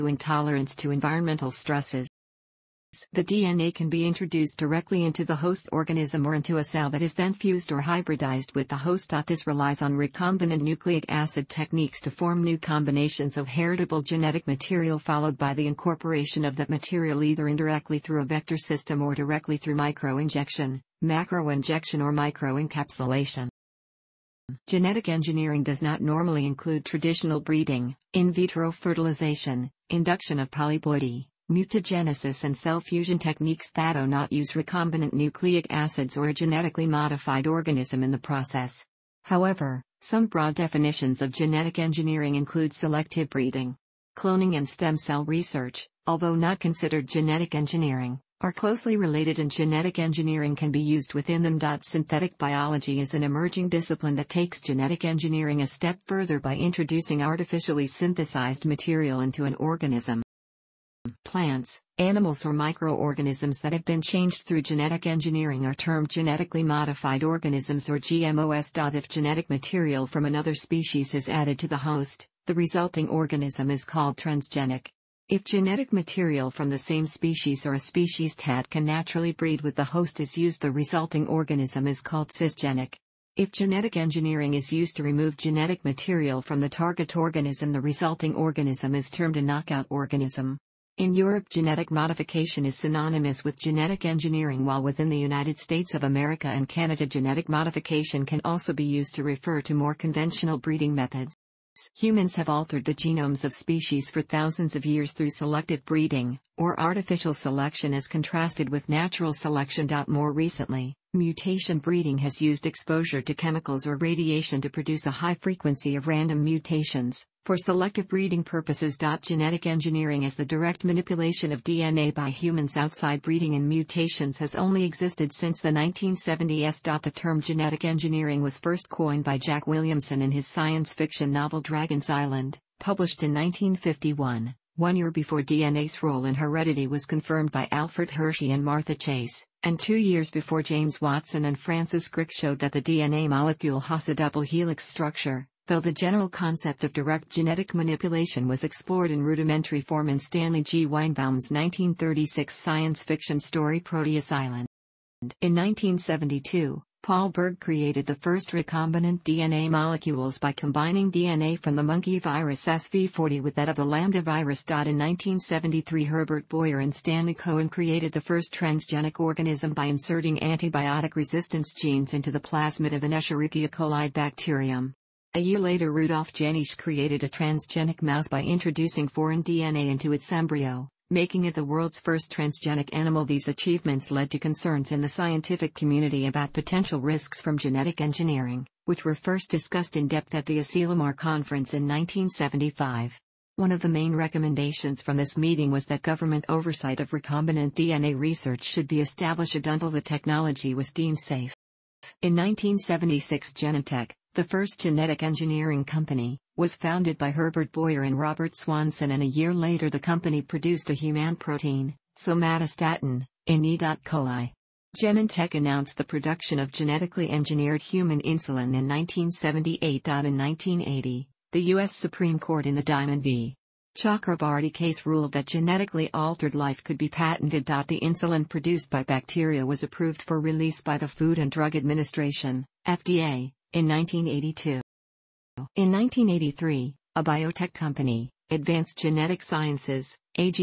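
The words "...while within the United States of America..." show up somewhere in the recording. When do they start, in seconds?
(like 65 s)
94 s.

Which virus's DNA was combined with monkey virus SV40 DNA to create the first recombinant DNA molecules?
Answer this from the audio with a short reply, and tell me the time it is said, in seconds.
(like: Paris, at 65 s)
lambda virus, at 163 s.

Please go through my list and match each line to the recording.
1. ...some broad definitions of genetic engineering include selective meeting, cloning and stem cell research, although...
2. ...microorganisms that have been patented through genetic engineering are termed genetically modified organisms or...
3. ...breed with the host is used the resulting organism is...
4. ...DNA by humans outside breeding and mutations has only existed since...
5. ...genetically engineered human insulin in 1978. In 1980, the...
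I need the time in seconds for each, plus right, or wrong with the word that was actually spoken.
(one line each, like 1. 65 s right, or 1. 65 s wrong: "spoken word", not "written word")
1. 40 s wrong: "breeding", not "meeting"
2. 62 s wrong: "changed", not "patented"
3. 79 s right
4. 121 s right
5. 216 s right.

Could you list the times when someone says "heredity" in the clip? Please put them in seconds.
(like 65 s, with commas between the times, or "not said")
136 s.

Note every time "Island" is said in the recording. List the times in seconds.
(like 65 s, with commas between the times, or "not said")
132 s, 154 s.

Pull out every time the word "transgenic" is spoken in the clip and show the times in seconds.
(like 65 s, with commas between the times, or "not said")
74 s, 168 s, 177 s, 182 s.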